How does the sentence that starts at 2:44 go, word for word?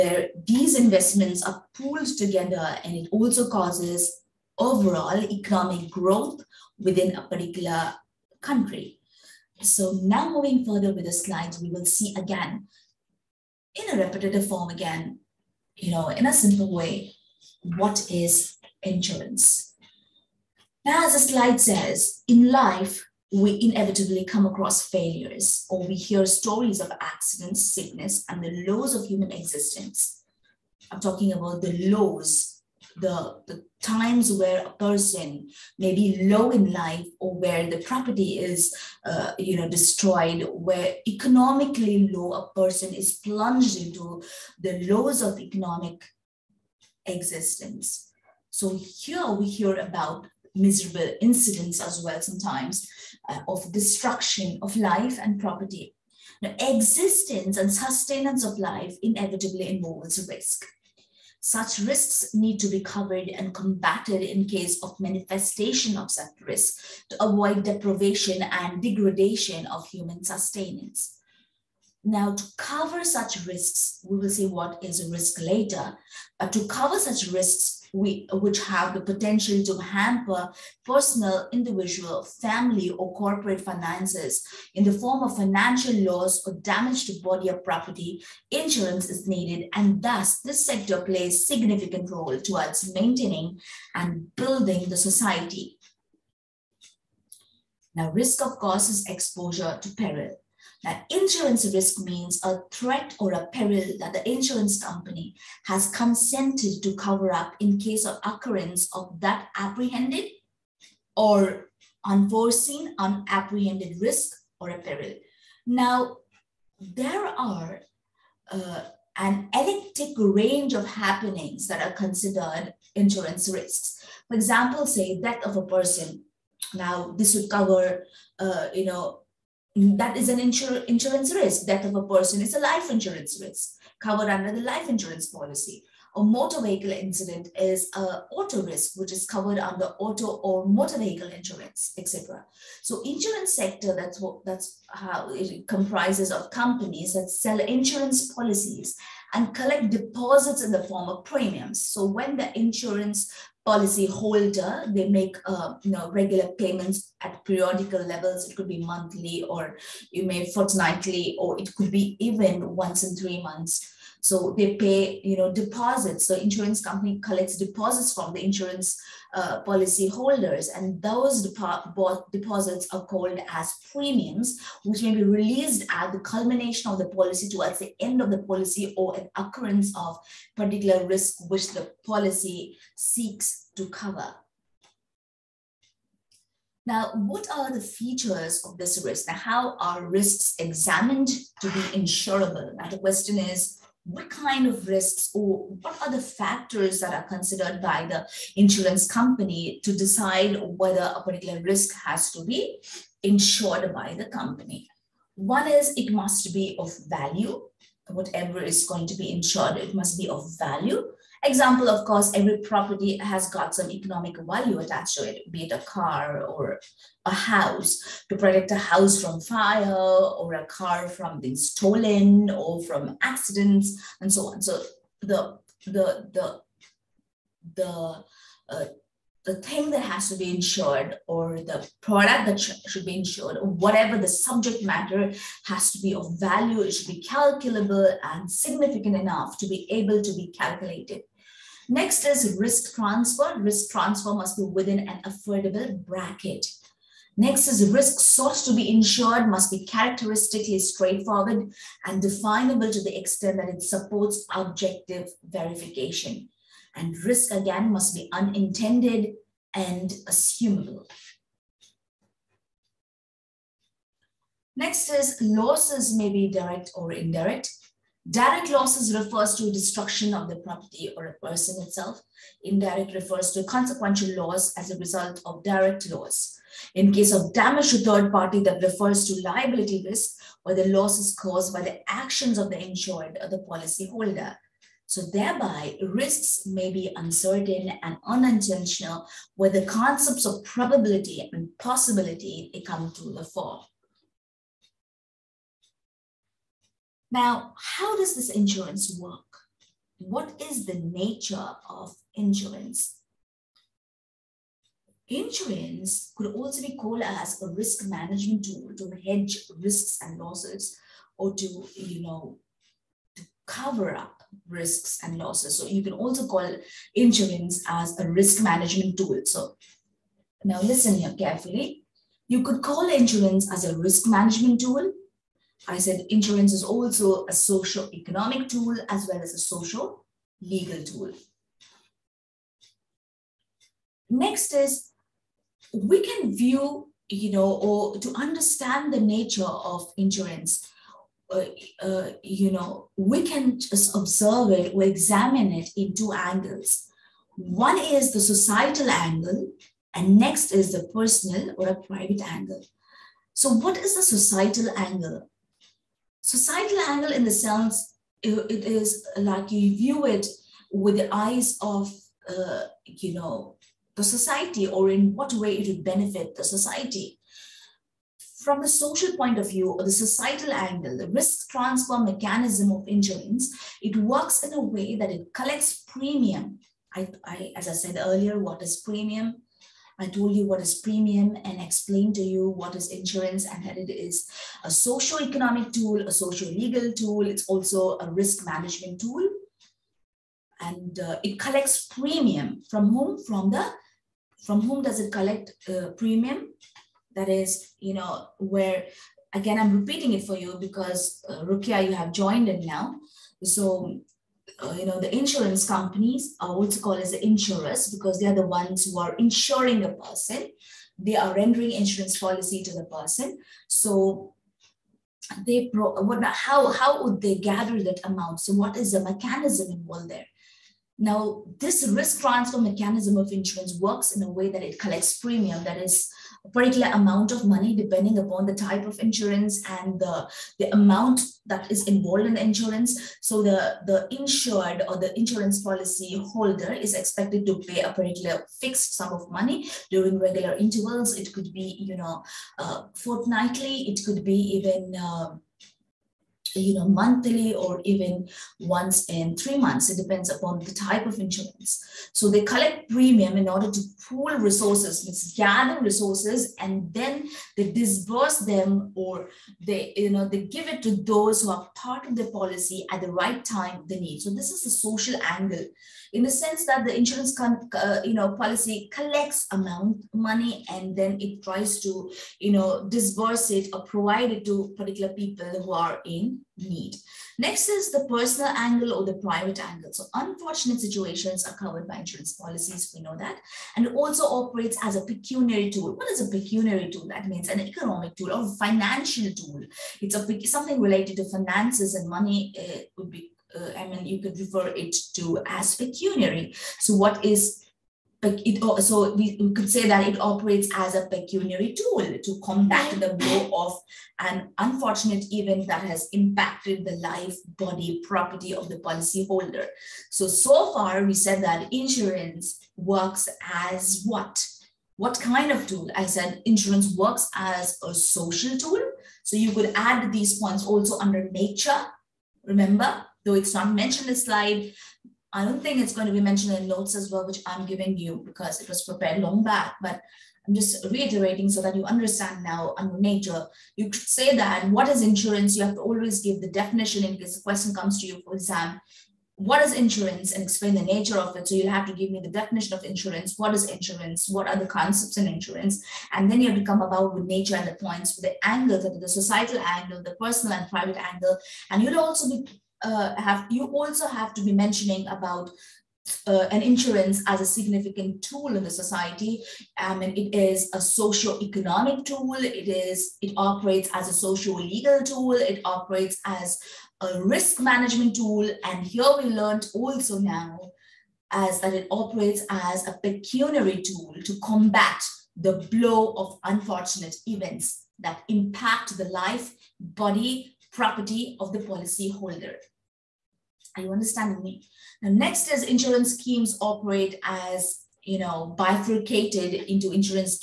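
So they pay, you know, deposits.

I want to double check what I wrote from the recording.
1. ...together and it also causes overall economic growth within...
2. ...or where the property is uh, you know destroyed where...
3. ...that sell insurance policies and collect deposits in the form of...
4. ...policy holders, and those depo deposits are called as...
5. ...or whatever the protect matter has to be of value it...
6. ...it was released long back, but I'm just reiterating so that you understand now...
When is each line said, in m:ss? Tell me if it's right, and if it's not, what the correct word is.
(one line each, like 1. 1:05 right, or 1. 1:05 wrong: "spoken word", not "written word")
1. 0:02 right
2. 0:37 right
3. 2:27 right
4. 2:49 right
5. 3:53 wrong: "subject", not "protect"
6. 8:48 wrong: "prepared", not "released".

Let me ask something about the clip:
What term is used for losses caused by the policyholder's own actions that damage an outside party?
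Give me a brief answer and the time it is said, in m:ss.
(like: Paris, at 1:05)
liability risk, at 4:39.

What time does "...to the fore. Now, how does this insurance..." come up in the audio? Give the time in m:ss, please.
4:53.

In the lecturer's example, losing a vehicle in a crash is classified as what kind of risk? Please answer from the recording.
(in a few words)
auto risk.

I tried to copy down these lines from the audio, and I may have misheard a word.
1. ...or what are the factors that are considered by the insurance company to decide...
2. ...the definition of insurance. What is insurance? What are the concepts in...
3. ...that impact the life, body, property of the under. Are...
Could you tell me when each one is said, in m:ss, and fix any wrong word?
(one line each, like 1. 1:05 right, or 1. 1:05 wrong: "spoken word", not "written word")
1. 3:15 right
2. 9:02 right
3. 9:38 wrong: "policyholder", not "under".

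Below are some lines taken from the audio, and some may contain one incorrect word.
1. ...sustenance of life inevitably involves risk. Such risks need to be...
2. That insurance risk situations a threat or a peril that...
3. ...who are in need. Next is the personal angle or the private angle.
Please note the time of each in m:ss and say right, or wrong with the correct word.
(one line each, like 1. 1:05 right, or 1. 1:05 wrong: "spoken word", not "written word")
1. 0:57 right
2. 1:40 wrong: "means", not "situations"
3. 7:55 right.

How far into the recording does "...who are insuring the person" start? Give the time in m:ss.
6:49.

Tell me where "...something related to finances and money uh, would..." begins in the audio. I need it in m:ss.
8:10.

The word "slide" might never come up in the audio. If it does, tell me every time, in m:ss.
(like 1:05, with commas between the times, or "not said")
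0:11, 0:21, 8:44.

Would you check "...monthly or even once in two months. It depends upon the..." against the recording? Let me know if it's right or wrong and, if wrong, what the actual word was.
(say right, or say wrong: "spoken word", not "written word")
wrong: "three", not "two".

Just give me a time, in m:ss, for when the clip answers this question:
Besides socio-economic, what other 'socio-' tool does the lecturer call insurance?
5:29.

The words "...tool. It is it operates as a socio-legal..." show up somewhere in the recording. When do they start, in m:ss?
9:22.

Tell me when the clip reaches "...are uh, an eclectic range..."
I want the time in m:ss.
1:57.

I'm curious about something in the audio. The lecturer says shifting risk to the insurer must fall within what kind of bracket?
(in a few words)
affordable.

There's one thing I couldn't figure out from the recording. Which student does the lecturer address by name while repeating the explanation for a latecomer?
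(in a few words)
Rukia.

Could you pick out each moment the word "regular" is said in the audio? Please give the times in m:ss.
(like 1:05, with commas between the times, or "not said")
2:36, 7:20.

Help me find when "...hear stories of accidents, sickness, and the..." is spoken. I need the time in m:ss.
0:25.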